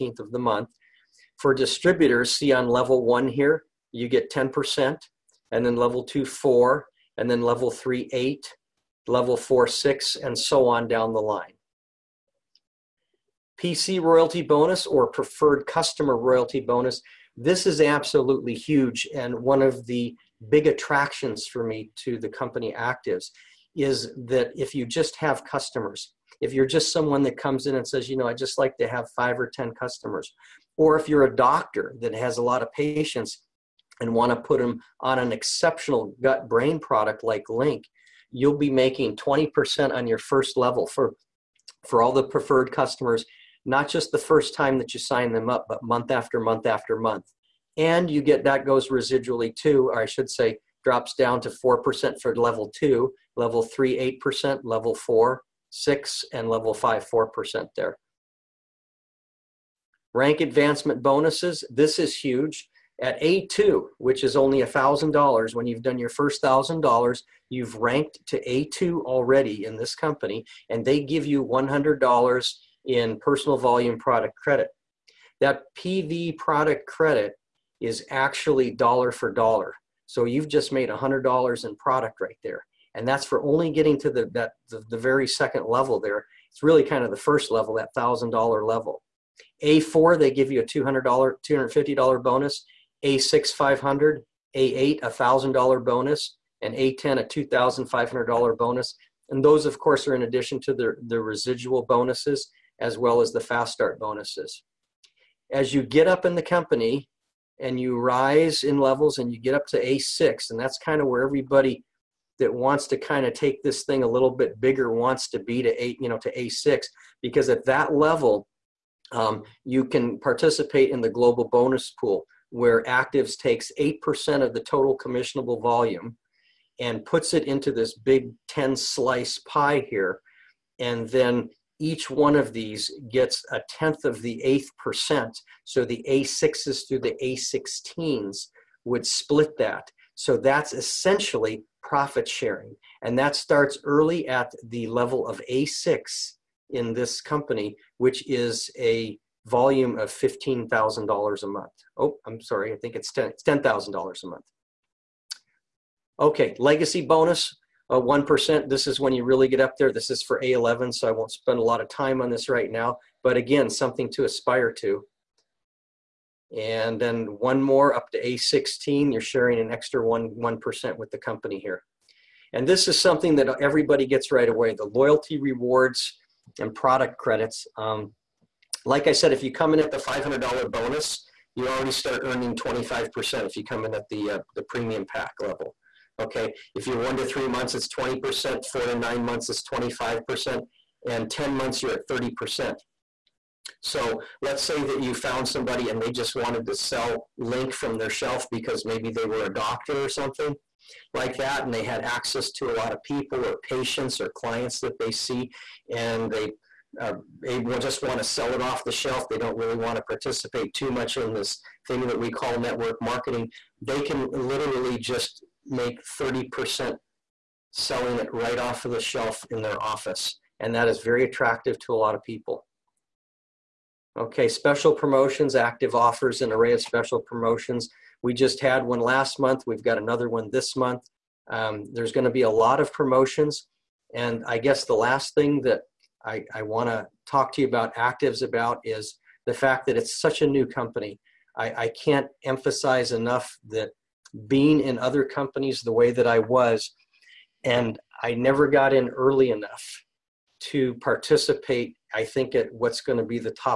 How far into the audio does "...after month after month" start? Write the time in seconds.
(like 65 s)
46 s.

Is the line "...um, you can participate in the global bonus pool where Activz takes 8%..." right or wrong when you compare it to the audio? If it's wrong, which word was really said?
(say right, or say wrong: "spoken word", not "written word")
right.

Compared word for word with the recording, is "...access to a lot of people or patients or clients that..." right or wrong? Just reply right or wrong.
right.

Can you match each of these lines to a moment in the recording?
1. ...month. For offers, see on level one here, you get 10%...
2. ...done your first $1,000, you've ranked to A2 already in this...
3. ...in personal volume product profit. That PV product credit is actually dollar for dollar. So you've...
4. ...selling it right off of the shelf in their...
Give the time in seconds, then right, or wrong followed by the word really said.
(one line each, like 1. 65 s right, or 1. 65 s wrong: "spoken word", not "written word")
1. 0 s wrong: "distributors", not "offers"
2. 65 s right
3. 72 s wrong: "credit", not "profit"
4. 217 s right.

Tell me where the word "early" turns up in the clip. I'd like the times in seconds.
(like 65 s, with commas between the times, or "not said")
143 s, 249 s.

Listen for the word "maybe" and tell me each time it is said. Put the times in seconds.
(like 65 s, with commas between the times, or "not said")
198 s.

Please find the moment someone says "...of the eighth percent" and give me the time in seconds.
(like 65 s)
134 s.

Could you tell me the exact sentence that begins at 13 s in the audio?
PC royalty bonus or preferred customer royalty bonus.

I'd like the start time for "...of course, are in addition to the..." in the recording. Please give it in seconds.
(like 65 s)
99 s.